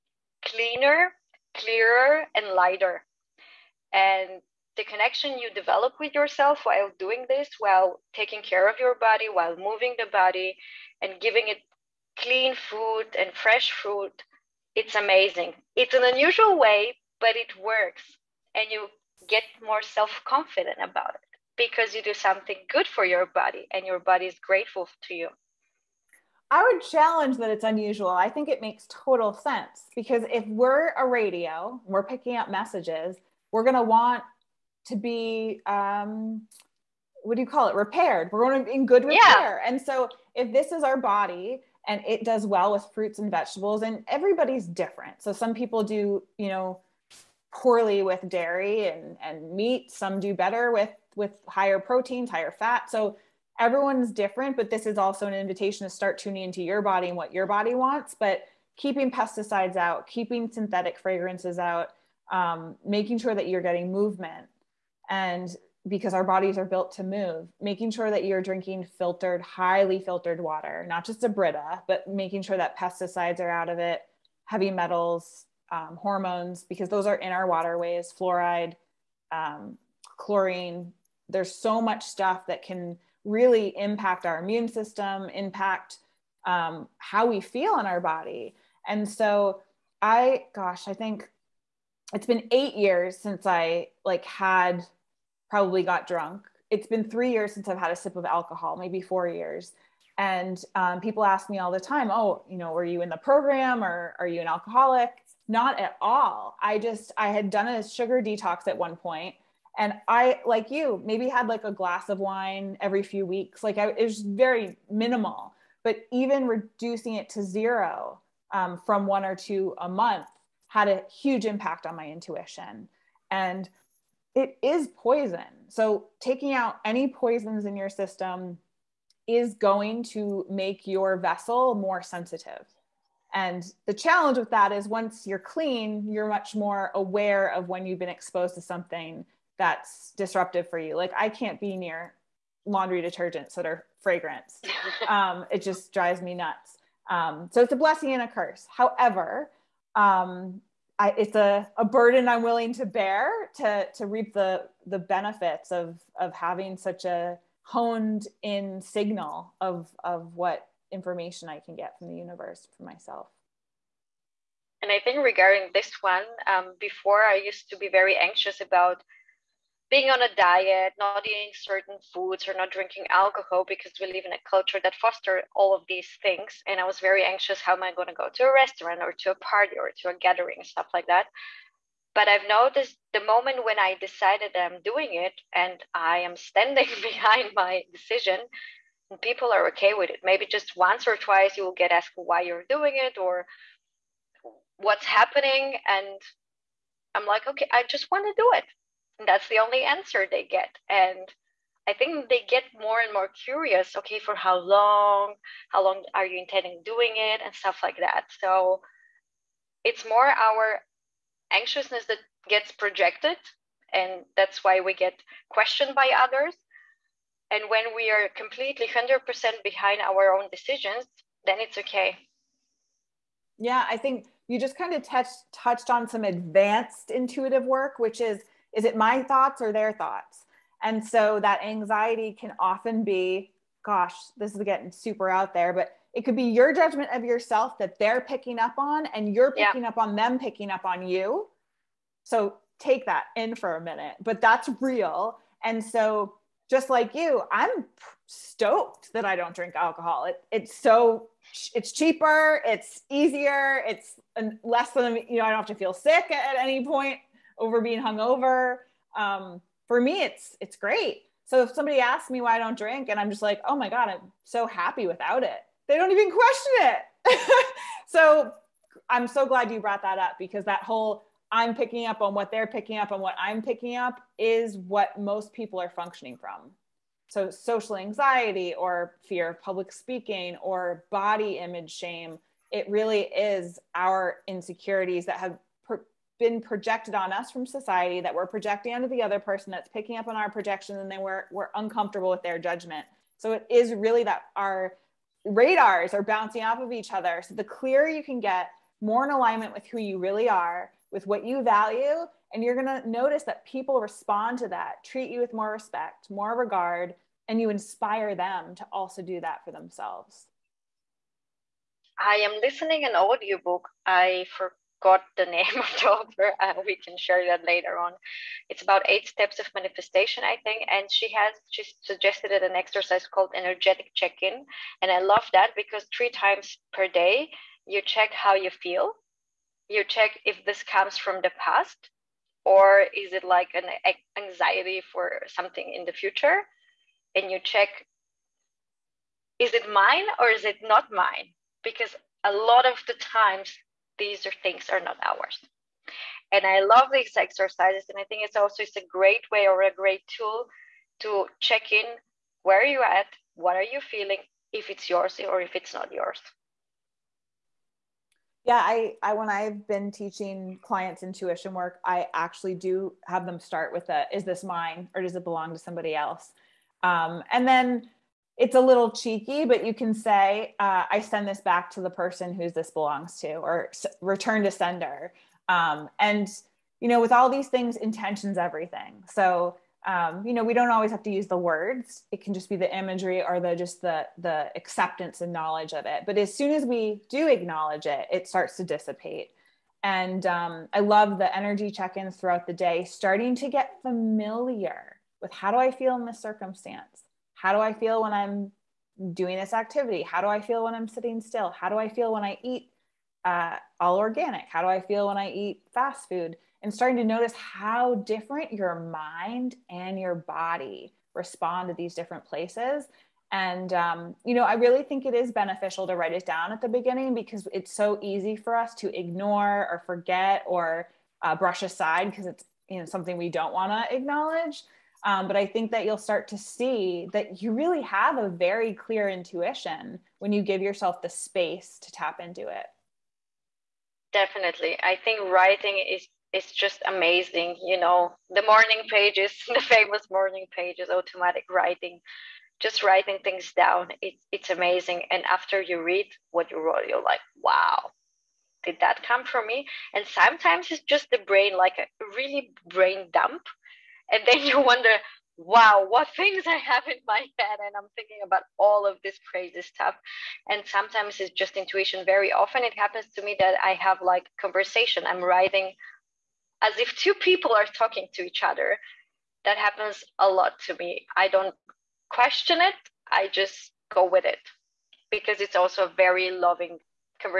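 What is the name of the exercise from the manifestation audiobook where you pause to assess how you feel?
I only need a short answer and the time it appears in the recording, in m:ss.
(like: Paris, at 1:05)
Energetic check-in, at 5:23.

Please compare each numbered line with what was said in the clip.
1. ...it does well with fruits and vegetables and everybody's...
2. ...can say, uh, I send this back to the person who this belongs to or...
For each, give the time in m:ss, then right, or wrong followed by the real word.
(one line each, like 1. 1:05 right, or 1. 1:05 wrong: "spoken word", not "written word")
1. 0:42 right
2. 6:09 right.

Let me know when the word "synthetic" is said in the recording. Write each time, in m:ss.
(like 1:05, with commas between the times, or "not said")
1:00.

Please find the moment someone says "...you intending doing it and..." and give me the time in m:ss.
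3:26.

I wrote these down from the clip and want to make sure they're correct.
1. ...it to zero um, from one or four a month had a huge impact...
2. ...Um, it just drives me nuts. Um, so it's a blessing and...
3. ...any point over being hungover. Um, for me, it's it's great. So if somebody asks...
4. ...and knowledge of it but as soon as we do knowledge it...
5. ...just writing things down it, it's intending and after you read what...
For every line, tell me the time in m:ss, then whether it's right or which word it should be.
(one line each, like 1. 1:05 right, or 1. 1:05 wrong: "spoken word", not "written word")
1. 1:57 wrong: "two", not "four"
2. 2:25 right
3. 4:16 right
4. 6:25 wrong: "acknowledge", not "knowledge"
5. 7:22 wrong: "amazing", not "intending".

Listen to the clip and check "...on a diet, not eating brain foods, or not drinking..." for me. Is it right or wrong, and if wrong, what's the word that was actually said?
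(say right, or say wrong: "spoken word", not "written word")
wrong: "certain", not "brain".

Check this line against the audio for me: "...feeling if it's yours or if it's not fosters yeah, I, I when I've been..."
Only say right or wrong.
wrong.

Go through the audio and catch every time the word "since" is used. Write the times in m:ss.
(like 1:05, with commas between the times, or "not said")
1:33, 1:37.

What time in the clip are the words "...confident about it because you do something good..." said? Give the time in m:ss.
0:20.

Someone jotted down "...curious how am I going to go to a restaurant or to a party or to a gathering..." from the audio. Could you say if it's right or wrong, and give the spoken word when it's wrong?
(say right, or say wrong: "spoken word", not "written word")
wrong: "anxious", not "curious".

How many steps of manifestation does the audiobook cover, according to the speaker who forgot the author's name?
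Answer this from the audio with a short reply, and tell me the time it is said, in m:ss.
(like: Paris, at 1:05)
8, at 5:19.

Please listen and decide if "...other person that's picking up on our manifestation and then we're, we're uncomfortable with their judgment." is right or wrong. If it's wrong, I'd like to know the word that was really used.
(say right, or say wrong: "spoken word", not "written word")
wrong: "projection", not "manifestation".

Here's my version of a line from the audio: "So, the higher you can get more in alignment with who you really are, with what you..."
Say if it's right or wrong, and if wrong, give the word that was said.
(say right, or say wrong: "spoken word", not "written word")
wrong: "clearer", not "higher".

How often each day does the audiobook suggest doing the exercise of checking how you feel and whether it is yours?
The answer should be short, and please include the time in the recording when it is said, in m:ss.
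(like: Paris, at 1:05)
3 times per day, at 5:26.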